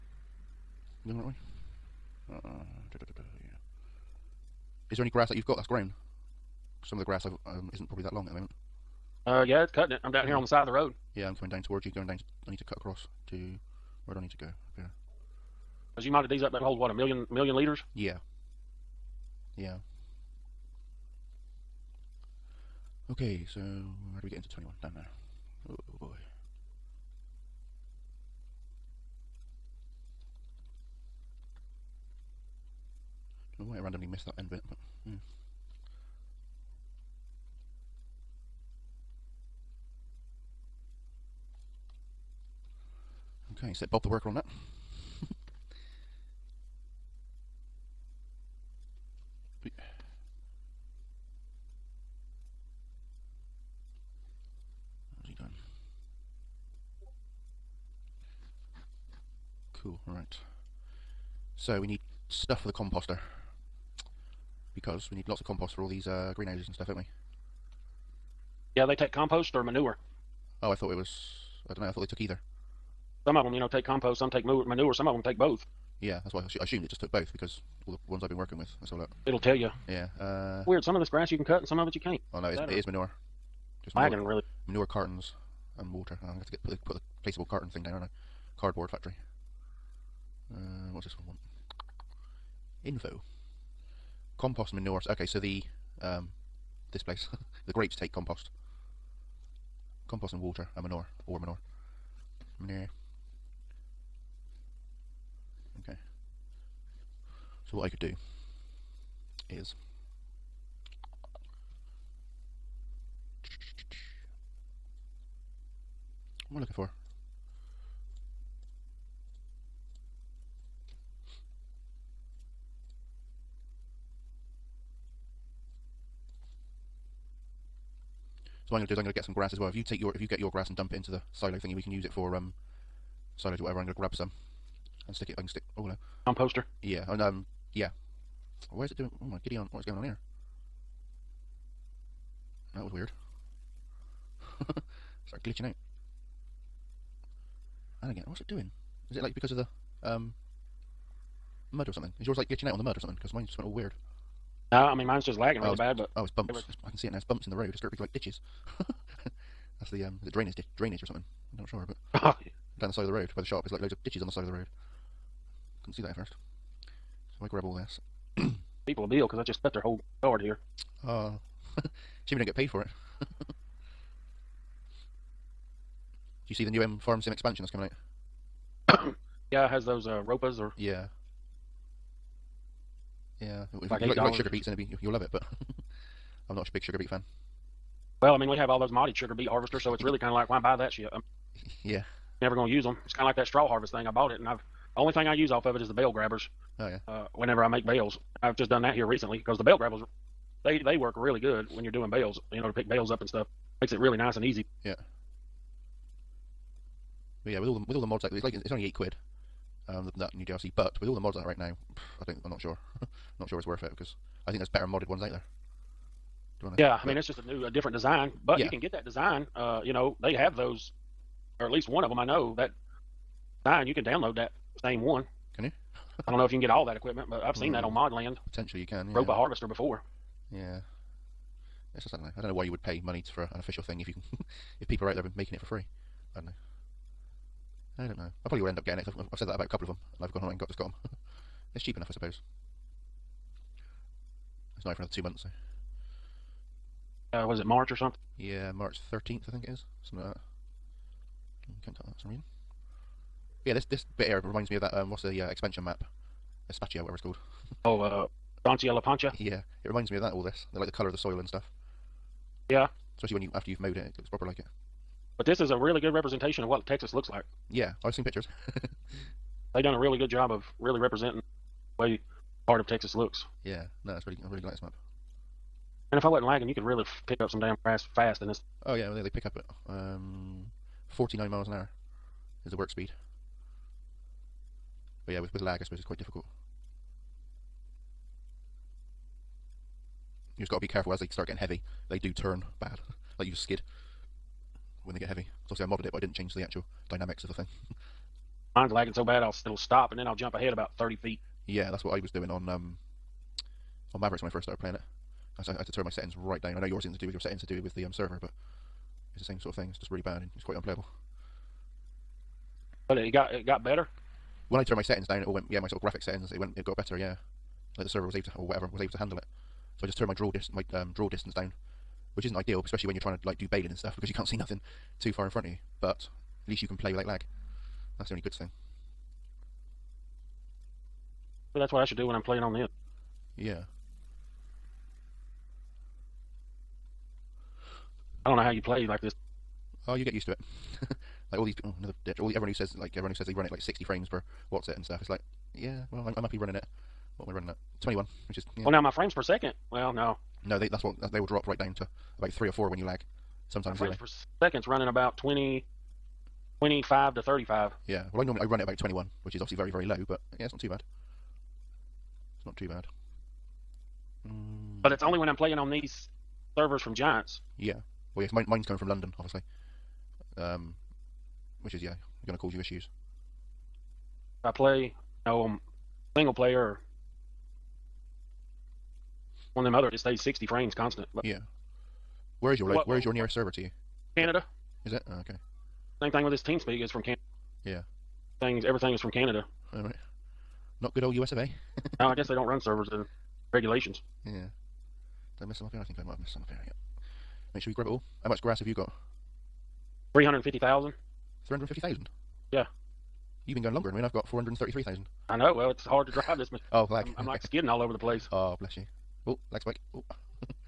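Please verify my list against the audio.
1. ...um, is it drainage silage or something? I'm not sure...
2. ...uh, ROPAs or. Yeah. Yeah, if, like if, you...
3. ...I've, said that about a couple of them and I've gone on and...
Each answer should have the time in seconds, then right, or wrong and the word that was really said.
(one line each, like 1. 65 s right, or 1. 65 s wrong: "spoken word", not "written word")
1. 160 s wrong: "drainage", not "silage"
2. 180 s right
3. 239 s right.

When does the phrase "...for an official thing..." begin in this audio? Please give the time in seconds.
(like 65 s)
233 s.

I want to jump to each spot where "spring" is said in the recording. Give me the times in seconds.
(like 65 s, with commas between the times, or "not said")
not said.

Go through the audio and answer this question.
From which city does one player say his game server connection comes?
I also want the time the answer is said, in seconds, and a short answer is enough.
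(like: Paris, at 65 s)
London, at 369 s.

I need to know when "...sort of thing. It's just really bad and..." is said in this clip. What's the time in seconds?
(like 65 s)
309 s.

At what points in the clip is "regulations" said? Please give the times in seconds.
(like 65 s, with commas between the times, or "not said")
393 s.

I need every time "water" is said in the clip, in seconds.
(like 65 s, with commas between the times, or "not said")
85 s, 100 s.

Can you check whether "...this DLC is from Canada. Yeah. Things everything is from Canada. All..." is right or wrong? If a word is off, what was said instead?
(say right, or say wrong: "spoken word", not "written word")
wrong: "TeamSpeak", not "DLC".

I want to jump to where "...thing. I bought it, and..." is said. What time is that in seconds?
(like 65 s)
193 s.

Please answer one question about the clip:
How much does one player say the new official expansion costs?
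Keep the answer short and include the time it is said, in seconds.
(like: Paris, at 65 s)
8 quid, at 208 s.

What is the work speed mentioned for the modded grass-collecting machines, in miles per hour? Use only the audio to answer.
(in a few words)
49.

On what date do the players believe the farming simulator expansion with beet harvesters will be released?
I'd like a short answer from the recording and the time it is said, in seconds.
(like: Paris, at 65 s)
March 13th, at 248 s.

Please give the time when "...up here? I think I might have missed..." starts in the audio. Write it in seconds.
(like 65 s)
395 s.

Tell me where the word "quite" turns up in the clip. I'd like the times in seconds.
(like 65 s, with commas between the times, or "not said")
286 s, 310 s.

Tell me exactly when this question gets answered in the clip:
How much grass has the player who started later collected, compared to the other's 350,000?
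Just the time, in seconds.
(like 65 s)
404 s.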